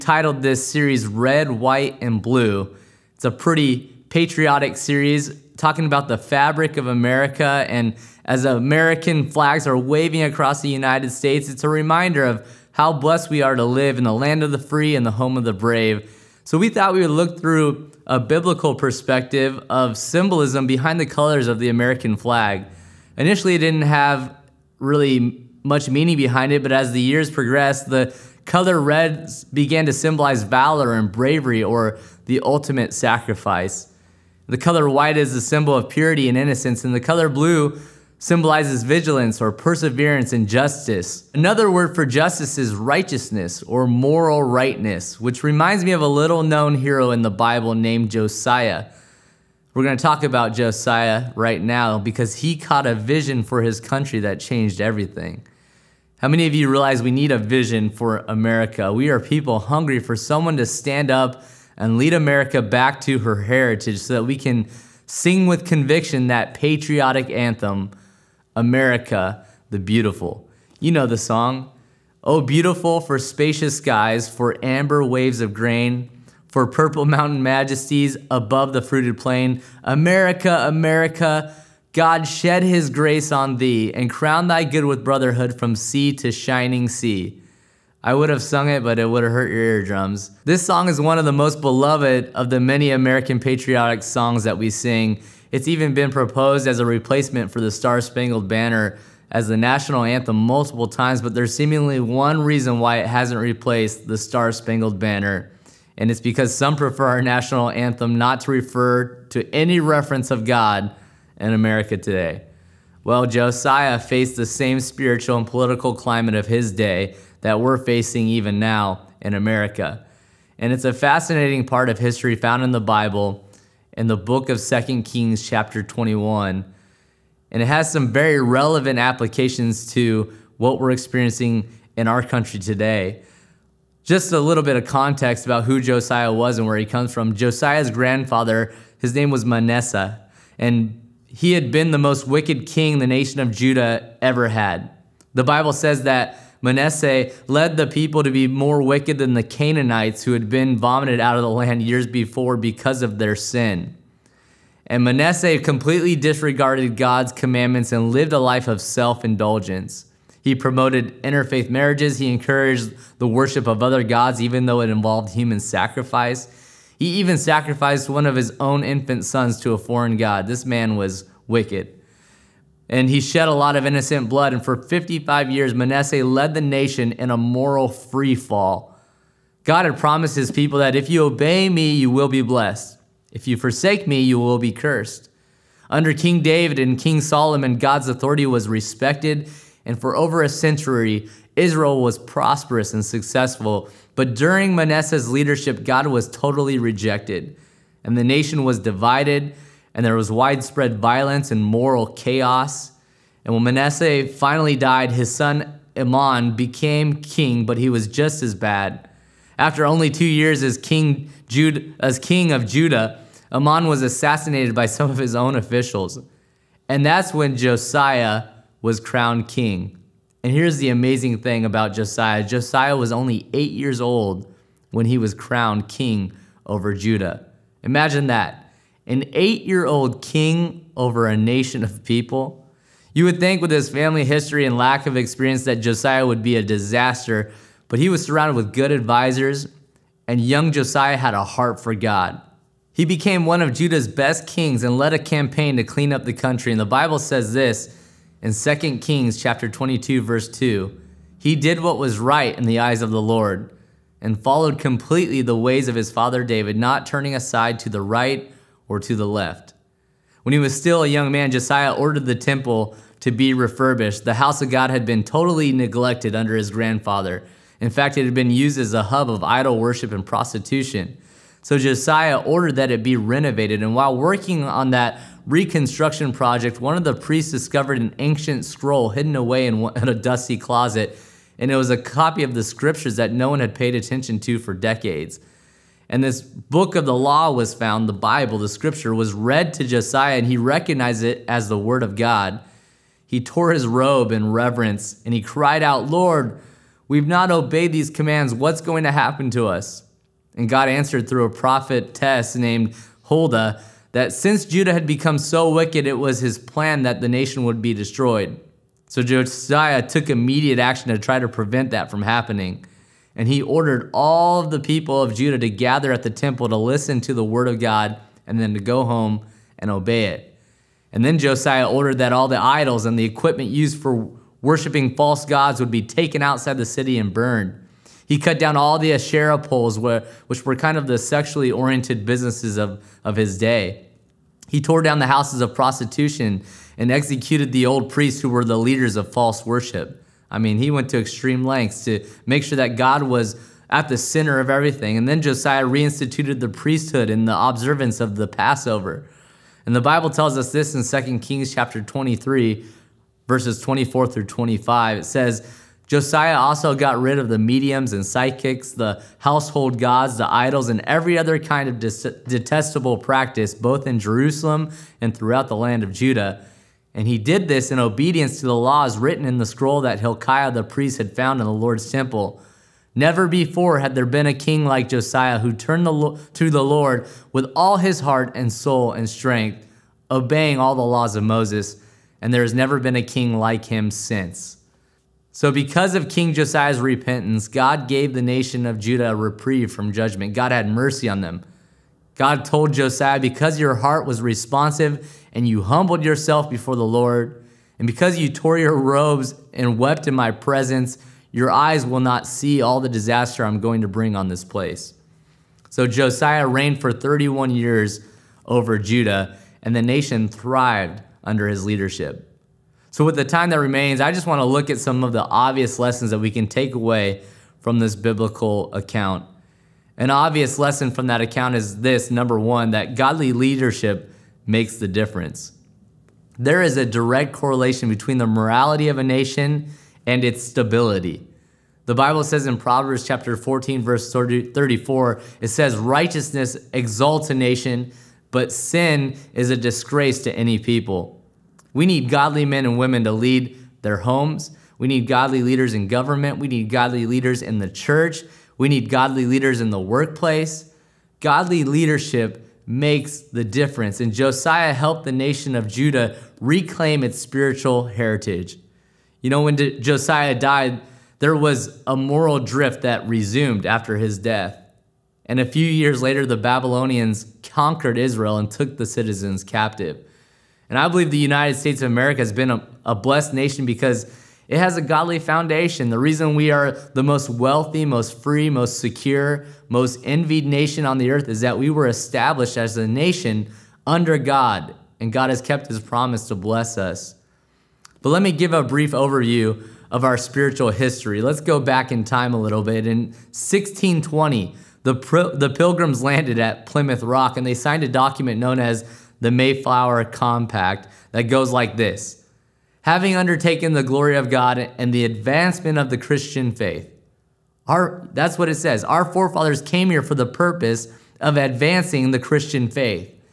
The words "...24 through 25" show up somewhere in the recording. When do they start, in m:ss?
5:53.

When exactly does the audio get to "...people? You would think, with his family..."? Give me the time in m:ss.
3:52.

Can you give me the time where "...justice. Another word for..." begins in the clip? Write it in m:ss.
0:40.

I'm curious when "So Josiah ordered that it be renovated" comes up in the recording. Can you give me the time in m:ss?
4:31.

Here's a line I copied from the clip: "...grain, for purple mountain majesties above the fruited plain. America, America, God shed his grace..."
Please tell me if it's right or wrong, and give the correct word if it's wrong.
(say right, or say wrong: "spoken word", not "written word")
right.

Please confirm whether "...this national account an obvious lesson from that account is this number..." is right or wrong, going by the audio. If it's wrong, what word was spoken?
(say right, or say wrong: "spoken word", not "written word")
wrong: "biblical", not "national".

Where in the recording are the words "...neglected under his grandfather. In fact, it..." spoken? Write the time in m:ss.
4:25.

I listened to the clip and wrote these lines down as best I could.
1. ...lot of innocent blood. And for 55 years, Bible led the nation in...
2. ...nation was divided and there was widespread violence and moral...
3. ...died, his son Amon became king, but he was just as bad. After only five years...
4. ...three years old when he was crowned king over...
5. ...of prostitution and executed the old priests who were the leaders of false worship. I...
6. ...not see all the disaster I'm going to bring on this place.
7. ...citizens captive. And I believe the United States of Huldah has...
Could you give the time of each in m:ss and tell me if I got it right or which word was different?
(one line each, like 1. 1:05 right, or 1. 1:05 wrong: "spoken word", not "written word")
1. 2:53 wrong: "Manasseh", not "Bible"
2. 3:18 right
3. 3:24 wrong: "two", not "five"
4. 3:43 wrong: "eight", not "three"
5. 5:35 right
6. 6:42 right
7. 7:49 wrong: "America", not "Huldah".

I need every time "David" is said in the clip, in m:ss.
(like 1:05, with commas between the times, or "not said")
3:06, 4:16.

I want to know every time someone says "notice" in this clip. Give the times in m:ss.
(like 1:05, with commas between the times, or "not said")
not said.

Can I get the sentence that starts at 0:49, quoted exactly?
We're going to talk about Josiah right now because he caught a vision for his country that changed everything.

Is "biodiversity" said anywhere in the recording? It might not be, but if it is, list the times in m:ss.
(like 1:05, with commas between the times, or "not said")
not said.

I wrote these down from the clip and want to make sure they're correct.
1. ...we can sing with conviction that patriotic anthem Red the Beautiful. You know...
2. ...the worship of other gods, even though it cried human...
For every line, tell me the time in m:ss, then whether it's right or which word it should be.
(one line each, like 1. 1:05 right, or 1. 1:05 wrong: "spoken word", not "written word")
1. 1:04 wrong: "America", not "Red"
2. 2:43 wrong: "involved", not "cried".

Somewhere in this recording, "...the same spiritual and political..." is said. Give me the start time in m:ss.
1:54.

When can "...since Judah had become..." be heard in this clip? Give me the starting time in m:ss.
5:04.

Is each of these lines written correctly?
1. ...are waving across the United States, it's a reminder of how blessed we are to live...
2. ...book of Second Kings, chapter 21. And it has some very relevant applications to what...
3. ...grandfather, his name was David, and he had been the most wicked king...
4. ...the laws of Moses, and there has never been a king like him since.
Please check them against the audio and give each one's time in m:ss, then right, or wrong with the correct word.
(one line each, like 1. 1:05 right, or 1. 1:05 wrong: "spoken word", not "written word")
1. 0:09 right
2. 2:04 right
3. 2:17 wrong: "Manasseh", not "David"
4. 6:20 right.